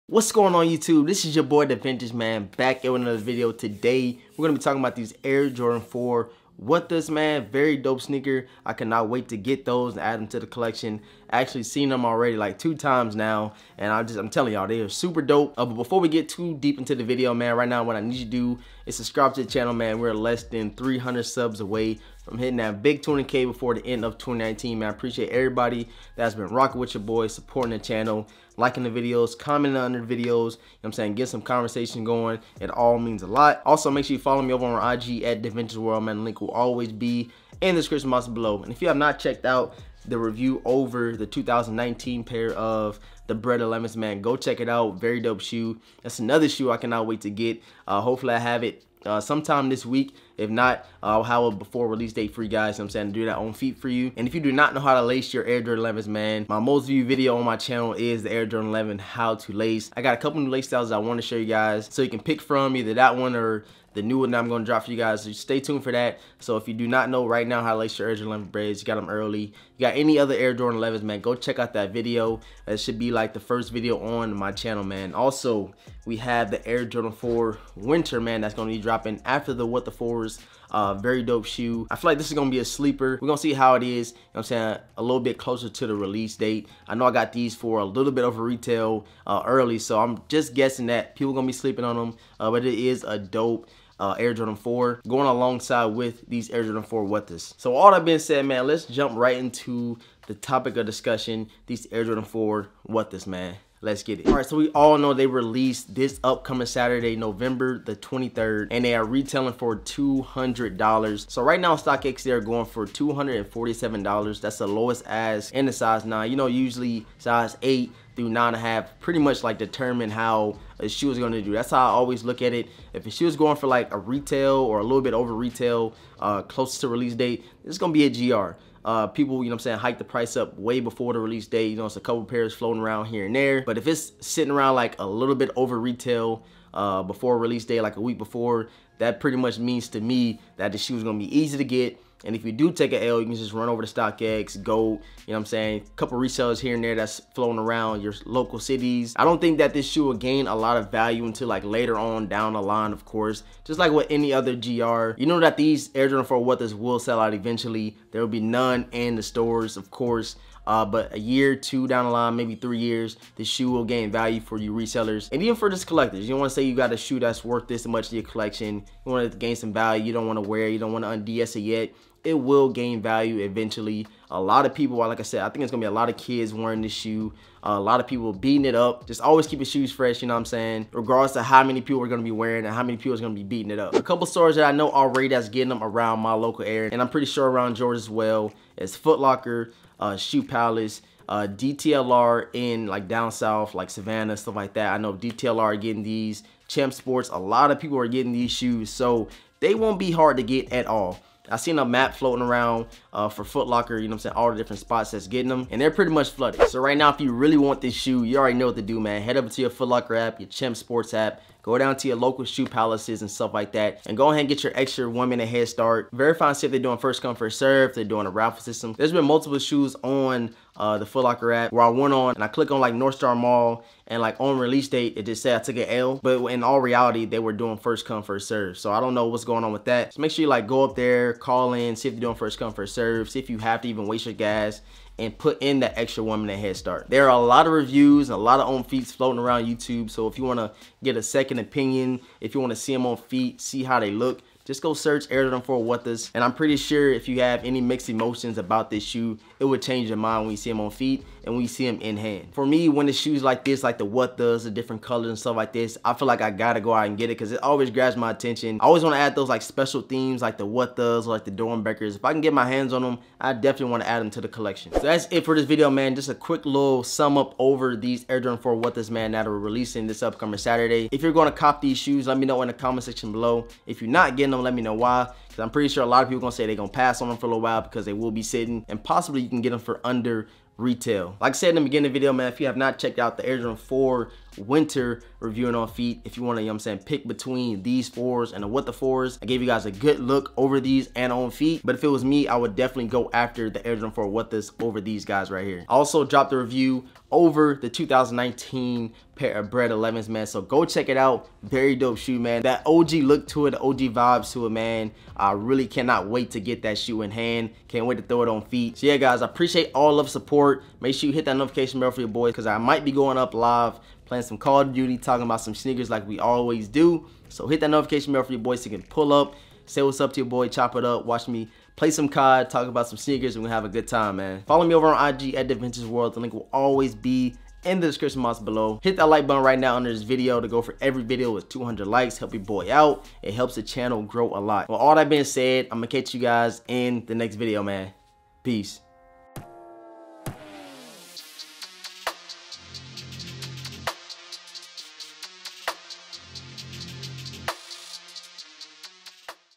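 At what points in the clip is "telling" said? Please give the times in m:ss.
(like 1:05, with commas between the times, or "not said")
0:14.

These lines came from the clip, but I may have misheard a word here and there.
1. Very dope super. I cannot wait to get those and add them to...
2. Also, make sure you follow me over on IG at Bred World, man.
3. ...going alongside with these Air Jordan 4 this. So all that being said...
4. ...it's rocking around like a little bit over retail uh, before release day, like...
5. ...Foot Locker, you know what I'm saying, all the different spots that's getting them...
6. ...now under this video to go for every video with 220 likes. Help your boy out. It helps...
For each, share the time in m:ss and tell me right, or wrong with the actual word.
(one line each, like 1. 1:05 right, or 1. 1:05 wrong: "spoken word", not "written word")
1. 0:07 wrong: "sneaker", not "super"
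2. 0:33 wrong: "Adventures", not "Bred"
3. 1:35 right
4. 2:13 wrong: "sitting", not "rocking"
5. 3:23 right
6. 5:29 wrong: "200", not "220".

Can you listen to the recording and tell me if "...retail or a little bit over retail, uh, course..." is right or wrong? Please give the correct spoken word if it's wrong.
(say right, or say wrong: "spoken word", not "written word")
wrong: "close", not "course".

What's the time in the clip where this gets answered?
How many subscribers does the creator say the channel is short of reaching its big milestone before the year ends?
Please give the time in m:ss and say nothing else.
0:20.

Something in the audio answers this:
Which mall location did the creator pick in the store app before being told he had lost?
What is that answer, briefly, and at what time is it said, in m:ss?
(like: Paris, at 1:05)
North Star Mall, at 3:42.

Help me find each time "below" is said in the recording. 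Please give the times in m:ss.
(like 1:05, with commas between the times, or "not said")
0:38, 4:33, 5:28.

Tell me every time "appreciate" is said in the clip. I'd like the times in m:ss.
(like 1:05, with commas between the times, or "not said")
0:24, 5:09.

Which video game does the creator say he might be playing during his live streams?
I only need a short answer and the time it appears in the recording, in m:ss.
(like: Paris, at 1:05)
Call of Duty, at 5:14.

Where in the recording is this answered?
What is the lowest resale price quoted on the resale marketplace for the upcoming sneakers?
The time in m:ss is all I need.
1:52.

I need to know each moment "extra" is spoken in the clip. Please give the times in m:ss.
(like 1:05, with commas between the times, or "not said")
3:34, 3:55.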